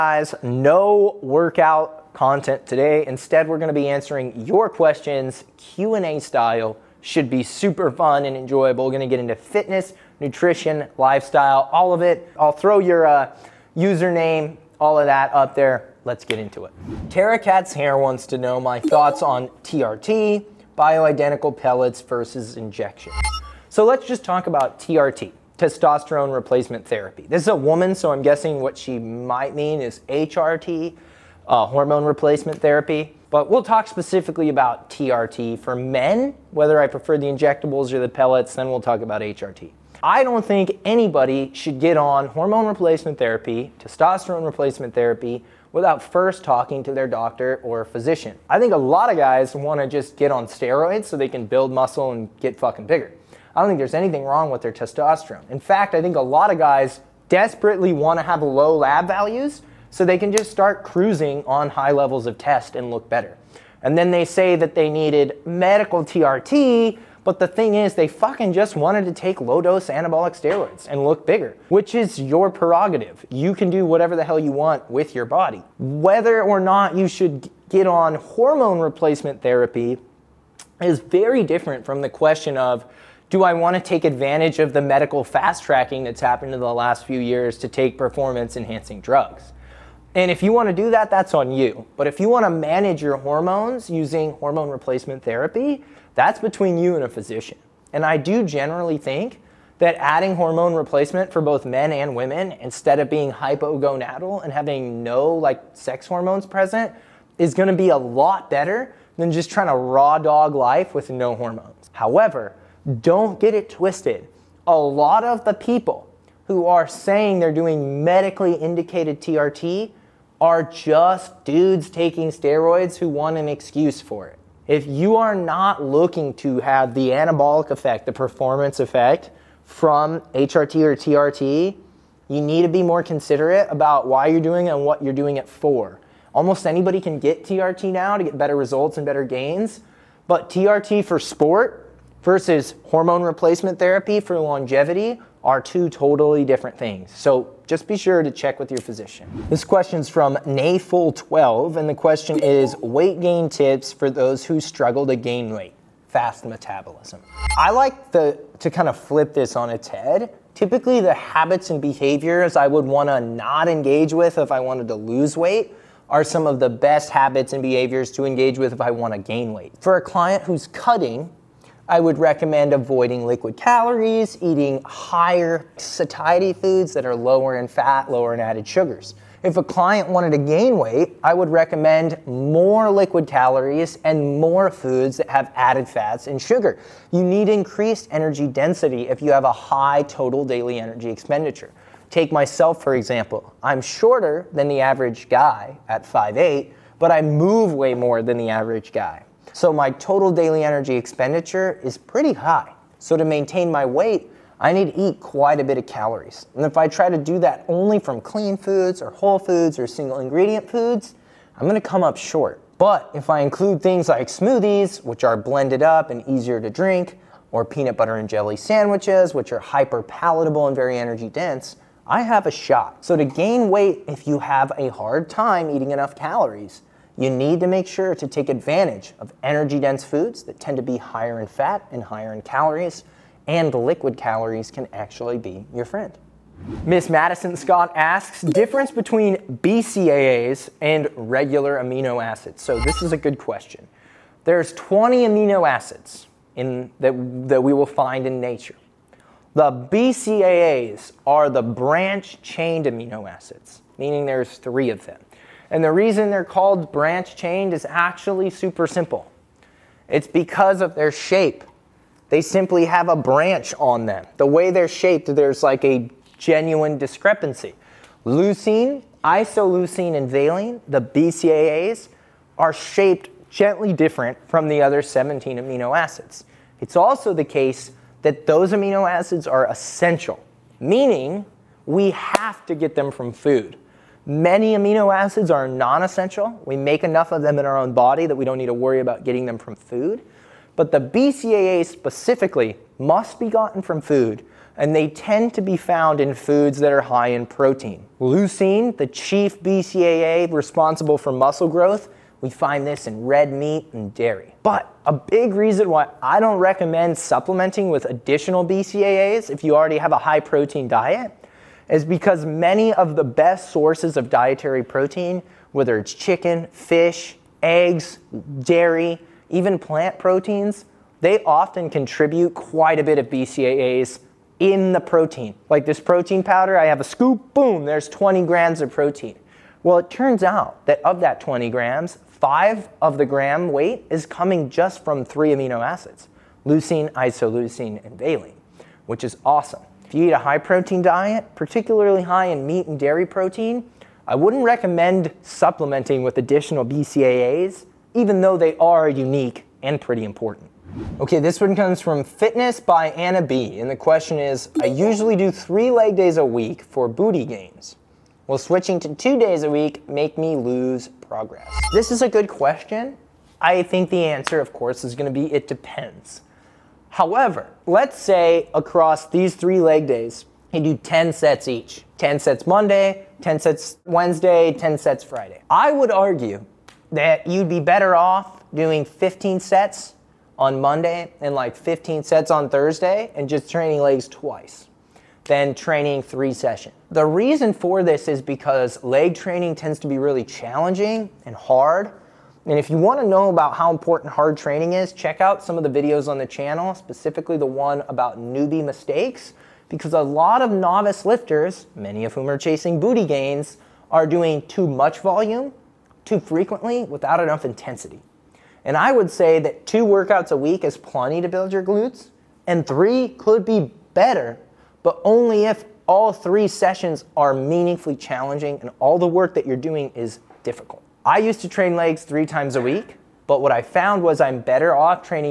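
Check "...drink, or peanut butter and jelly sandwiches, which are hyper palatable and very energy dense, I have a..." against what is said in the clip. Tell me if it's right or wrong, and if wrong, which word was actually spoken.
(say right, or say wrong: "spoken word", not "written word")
right.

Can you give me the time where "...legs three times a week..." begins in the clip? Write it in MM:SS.
07:01.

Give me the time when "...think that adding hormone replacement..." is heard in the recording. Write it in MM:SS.
01:38.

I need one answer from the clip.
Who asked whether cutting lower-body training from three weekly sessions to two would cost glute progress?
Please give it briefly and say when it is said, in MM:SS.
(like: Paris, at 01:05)
Fitness by Anna B, at 05:52.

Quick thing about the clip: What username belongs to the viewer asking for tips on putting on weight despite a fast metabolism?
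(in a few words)
Nayful12.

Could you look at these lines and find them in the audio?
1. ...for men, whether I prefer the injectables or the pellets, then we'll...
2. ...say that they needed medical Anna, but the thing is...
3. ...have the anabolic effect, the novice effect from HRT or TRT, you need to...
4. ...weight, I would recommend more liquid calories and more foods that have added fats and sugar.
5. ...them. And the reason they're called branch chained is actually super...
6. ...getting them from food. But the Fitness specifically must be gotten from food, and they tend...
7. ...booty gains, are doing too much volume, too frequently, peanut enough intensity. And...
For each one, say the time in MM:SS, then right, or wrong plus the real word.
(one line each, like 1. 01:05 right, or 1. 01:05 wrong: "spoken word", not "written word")
1. 00:35 right
2. 01:04 wrong: "TRT", not "Anna"
3. 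02:06 wrong: "performance", not "novice"
4. 03:00 right
5. 04:15 right
6. 04:49 wrong: "BCAA", not "Fitness"
7. 06:42 wrong: "without", not "peanut".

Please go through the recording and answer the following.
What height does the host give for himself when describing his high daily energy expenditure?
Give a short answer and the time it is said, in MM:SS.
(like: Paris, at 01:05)
5'8, at 03:16.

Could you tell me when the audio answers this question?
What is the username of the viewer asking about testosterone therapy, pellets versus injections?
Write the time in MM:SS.
00:17.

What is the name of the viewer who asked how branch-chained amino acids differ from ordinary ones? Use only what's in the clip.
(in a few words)
Miss Madison Scott.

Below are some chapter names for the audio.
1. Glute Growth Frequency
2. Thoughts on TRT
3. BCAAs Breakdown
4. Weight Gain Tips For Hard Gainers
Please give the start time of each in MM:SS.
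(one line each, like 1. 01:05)
1. 05:49
2. 00:19
3. 03:55
4. 02:28.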